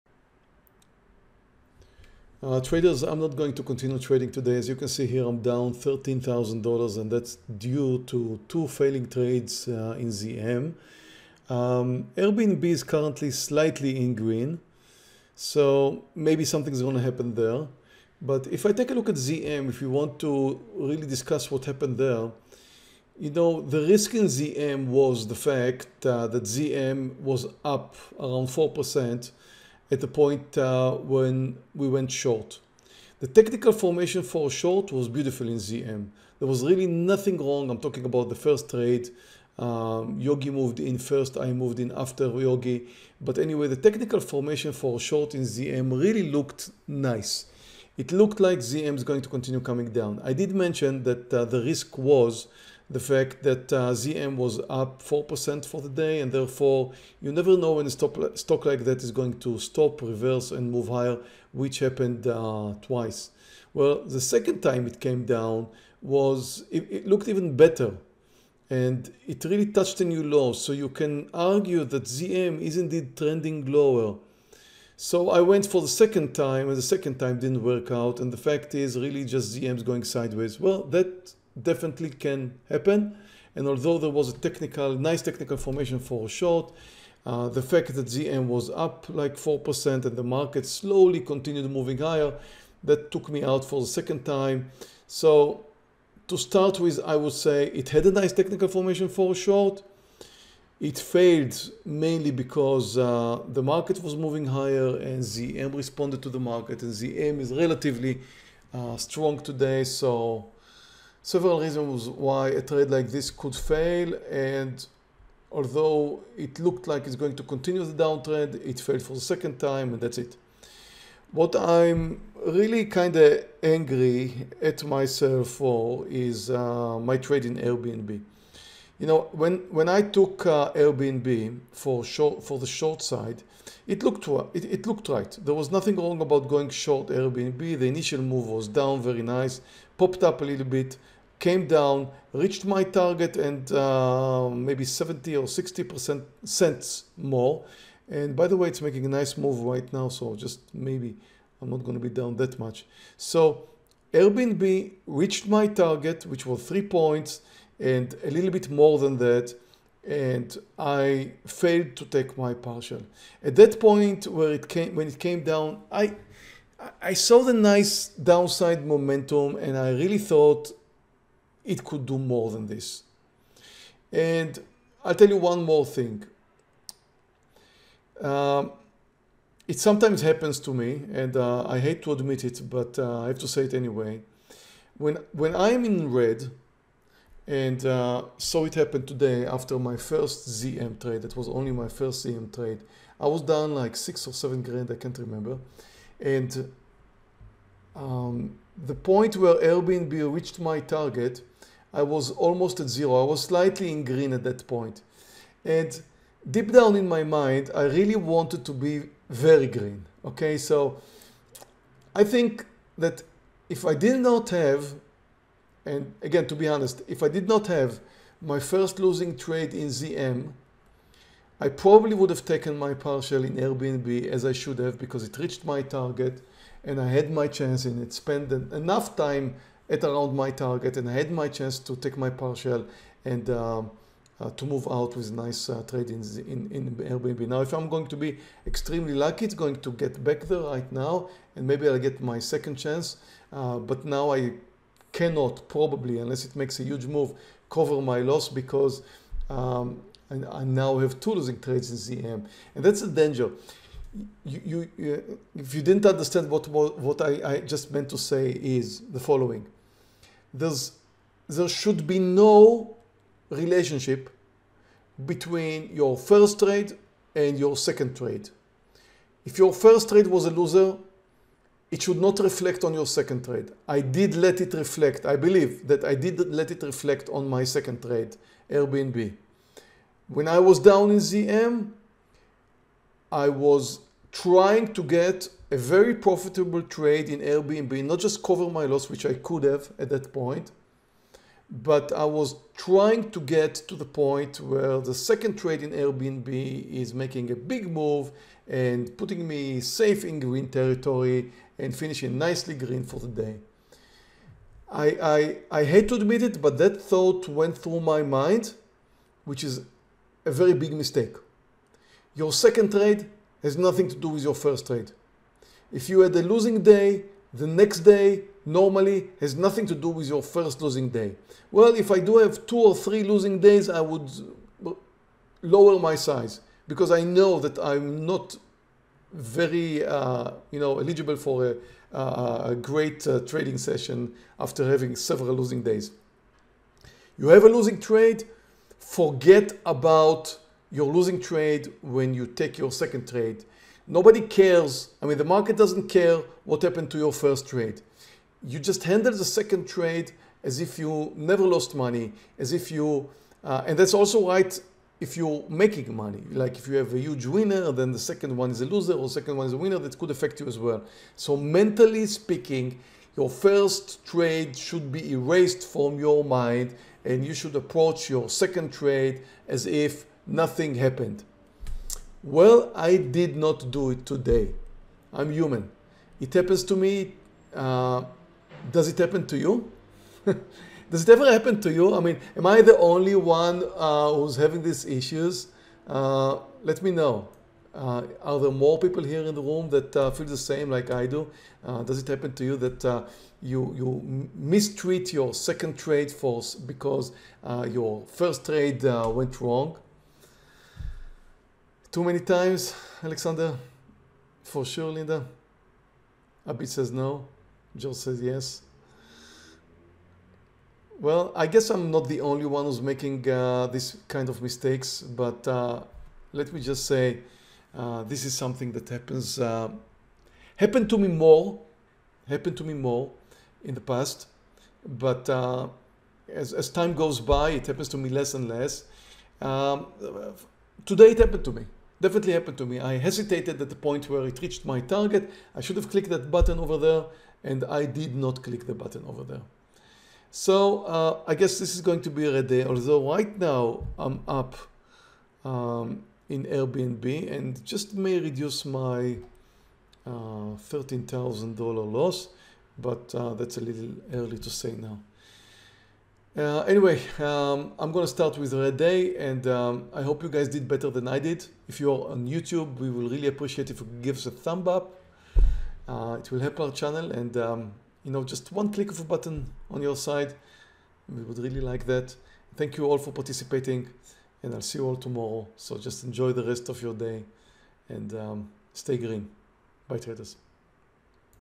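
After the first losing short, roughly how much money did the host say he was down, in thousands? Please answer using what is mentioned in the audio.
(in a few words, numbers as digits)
6 or 7 grand.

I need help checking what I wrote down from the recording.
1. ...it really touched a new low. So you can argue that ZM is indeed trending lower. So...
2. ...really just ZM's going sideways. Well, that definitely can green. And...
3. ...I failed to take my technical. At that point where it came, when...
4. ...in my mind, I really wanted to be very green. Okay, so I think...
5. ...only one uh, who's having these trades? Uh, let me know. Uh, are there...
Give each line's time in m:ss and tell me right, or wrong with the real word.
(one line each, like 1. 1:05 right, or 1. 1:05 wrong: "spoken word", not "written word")
1. 1:09 right
2. 1:18 wrong: "happen", not "green"
3. 2:40 wrong: "partial", not "technical"
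4. 3:26 right
5. 6:22 wrong: "issues", not "trades".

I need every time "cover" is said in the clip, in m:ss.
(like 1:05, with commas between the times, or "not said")
4:07, 4:48.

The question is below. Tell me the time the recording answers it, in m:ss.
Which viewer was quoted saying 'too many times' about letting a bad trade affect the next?
6:43.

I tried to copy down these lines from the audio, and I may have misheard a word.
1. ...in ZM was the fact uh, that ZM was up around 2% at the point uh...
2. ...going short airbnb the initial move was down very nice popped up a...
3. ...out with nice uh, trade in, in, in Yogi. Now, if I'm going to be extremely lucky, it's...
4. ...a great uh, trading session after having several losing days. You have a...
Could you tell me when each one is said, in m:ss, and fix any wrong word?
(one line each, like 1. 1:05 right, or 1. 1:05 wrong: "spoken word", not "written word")
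1. 0:24 wrong: "4", not "2"
2. 2:16 right
3. 3:54 wrong: "Airbnb", not "Yogi"
4. 5:32 right.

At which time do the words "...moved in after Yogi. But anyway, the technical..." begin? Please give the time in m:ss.
0:41.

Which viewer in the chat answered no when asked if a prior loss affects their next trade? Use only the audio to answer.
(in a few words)
Abby.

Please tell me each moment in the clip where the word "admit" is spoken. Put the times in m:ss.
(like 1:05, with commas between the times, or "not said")
3:02, 5:06.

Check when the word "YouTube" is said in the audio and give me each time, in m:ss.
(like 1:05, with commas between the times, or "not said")
7:42.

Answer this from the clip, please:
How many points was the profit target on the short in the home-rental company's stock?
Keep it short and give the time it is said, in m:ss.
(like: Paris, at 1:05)
3, at 2:36.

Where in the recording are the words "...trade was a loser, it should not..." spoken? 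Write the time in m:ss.
4:30.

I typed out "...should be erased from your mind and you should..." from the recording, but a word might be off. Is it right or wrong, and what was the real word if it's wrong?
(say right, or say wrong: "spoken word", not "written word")
right.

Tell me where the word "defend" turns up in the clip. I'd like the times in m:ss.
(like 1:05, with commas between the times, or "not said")
not said.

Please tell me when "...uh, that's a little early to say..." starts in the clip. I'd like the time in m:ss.
7:33.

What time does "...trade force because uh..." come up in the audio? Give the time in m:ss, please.
6:35.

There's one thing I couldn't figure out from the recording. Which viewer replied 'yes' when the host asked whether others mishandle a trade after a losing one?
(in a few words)
Joe.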